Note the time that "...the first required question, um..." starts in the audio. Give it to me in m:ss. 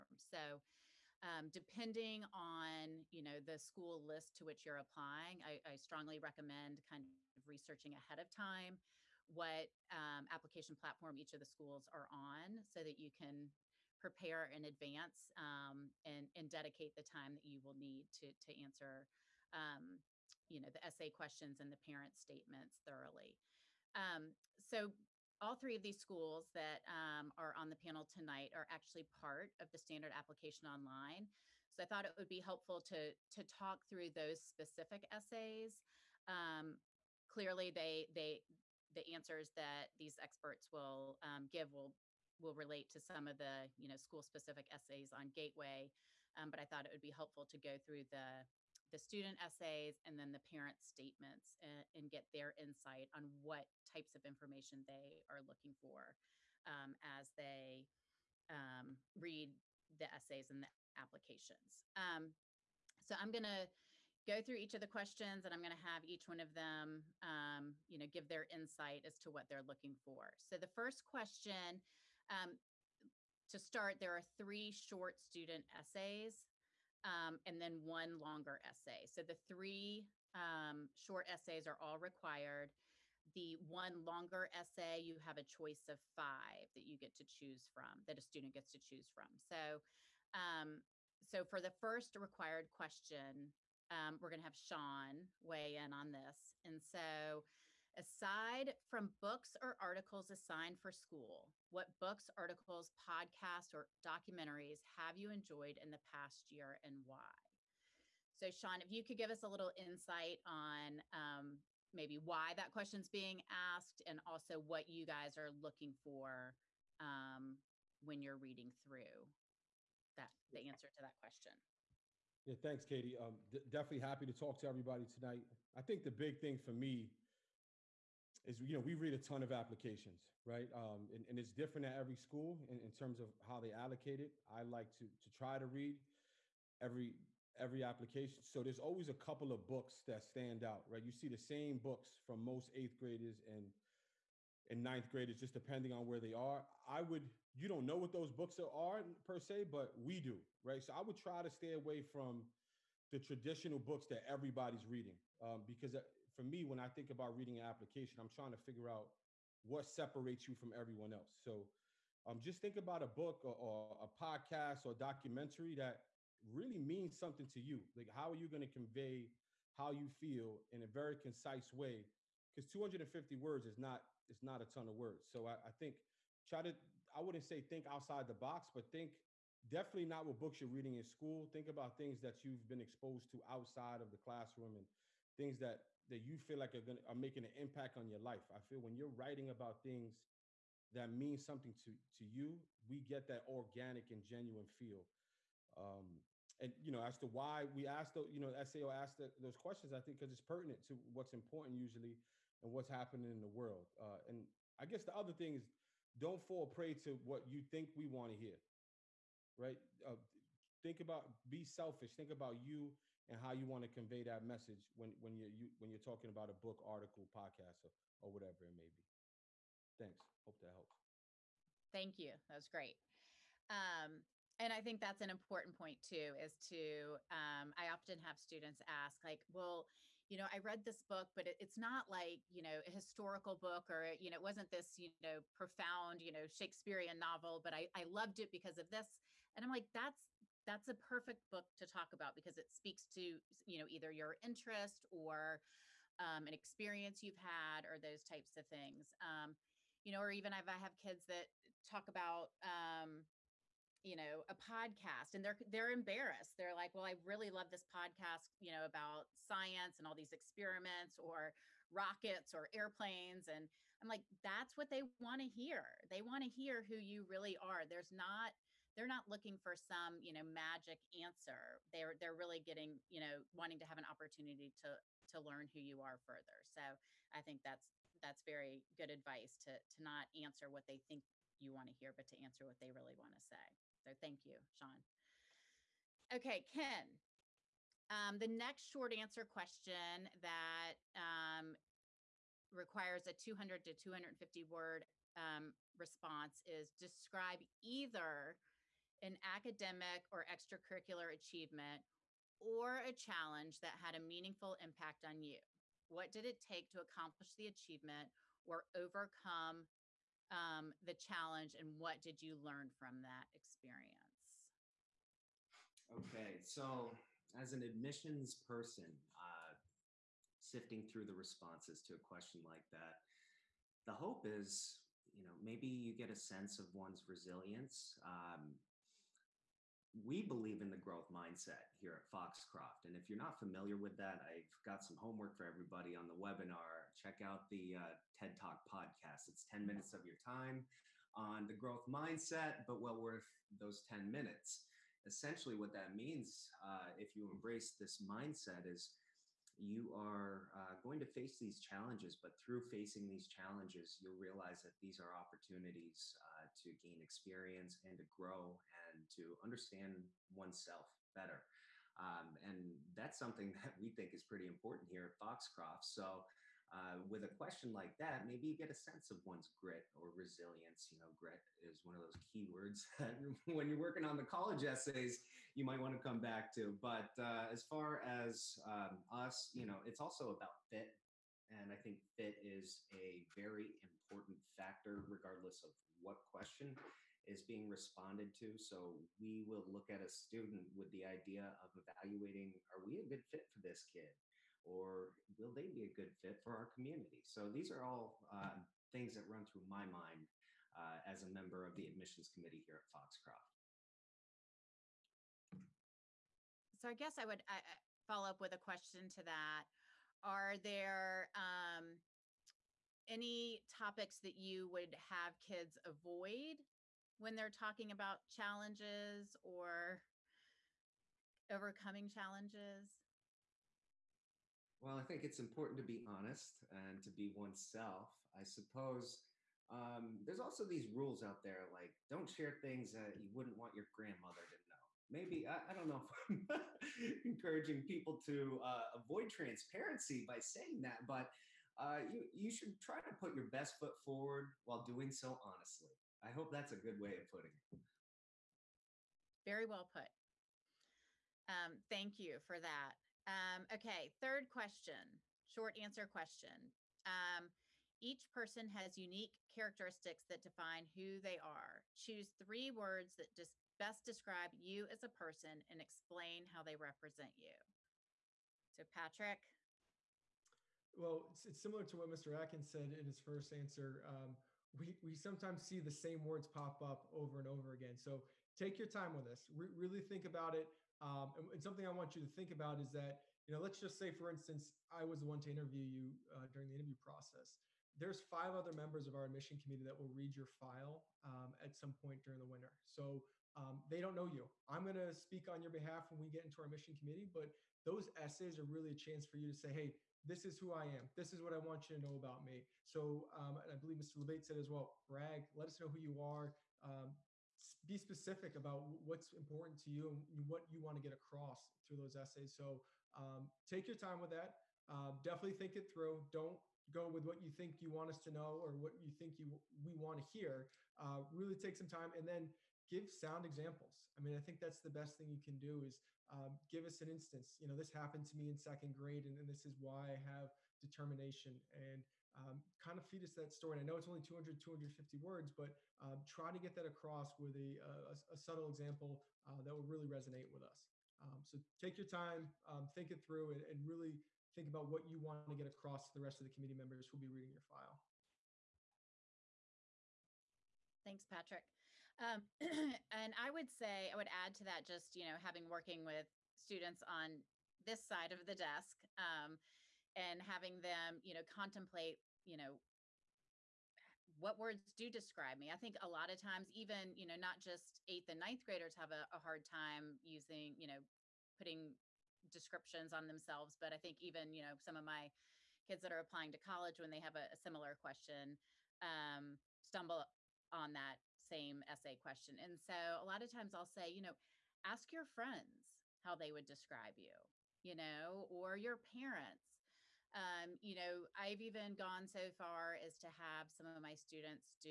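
1:31.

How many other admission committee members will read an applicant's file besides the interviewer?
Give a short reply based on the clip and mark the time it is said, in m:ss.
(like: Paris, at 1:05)
5, at 8:08.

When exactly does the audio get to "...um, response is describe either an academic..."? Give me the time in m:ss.
4:55.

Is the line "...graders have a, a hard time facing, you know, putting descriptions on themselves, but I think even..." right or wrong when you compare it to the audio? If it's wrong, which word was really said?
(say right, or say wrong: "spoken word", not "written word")
wrong: "using", not "facing".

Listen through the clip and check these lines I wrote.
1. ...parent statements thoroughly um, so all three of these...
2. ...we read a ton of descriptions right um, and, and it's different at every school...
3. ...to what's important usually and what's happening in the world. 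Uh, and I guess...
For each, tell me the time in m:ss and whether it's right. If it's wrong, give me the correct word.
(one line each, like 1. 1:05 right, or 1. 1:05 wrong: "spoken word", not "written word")
1. 0:21 right
2. 2:08 wrong: "applications", not "descriptions"
3. 3:20 right.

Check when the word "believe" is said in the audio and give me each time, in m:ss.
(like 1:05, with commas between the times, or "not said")
5:30, 8:23.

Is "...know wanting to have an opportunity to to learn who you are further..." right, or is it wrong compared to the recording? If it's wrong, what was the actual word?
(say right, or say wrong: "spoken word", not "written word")
right.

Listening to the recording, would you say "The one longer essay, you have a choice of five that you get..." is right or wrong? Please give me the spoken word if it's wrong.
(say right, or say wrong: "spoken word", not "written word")
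right.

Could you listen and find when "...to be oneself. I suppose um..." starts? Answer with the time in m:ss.
7:07.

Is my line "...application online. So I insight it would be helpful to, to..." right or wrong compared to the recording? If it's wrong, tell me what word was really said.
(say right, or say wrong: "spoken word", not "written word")
wrong: "thought", not "insight".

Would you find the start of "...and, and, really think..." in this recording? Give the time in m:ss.
9:03.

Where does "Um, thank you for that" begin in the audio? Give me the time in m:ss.
7:31.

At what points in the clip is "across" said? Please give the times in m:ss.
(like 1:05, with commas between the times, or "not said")
8:31, 8:57, 9:05.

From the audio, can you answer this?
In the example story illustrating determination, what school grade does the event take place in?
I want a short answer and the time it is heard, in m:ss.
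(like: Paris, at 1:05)
second grade, at 8:48.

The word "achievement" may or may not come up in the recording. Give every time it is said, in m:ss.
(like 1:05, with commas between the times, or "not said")
5:01, 5:07.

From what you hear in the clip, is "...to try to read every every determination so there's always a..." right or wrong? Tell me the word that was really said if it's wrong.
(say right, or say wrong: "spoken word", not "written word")
wrong: "application", not "determination".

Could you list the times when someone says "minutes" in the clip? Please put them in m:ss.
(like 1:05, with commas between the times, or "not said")
5:39, 5:44.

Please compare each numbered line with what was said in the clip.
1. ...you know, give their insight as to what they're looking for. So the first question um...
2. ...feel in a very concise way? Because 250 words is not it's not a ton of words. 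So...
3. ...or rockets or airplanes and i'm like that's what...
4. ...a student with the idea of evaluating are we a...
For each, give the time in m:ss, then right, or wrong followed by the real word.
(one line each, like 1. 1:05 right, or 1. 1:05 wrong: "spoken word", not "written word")
1. 1:07 right
2. 2:50 right
3. 4:21 right
4. 6:30 right.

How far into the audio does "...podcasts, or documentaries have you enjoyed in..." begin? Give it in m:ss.
1:42.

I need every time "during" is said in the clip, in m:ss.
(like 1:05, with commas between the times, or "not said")
8:06, 8:12.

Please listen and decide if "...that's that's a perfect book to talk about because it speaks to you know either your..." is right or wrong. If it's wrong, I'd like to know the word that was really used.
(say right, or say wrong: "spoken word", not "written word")
right.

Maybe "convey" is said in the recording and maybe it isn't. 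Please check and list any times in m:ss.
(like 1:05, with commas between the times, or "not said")
2:48, 3:33.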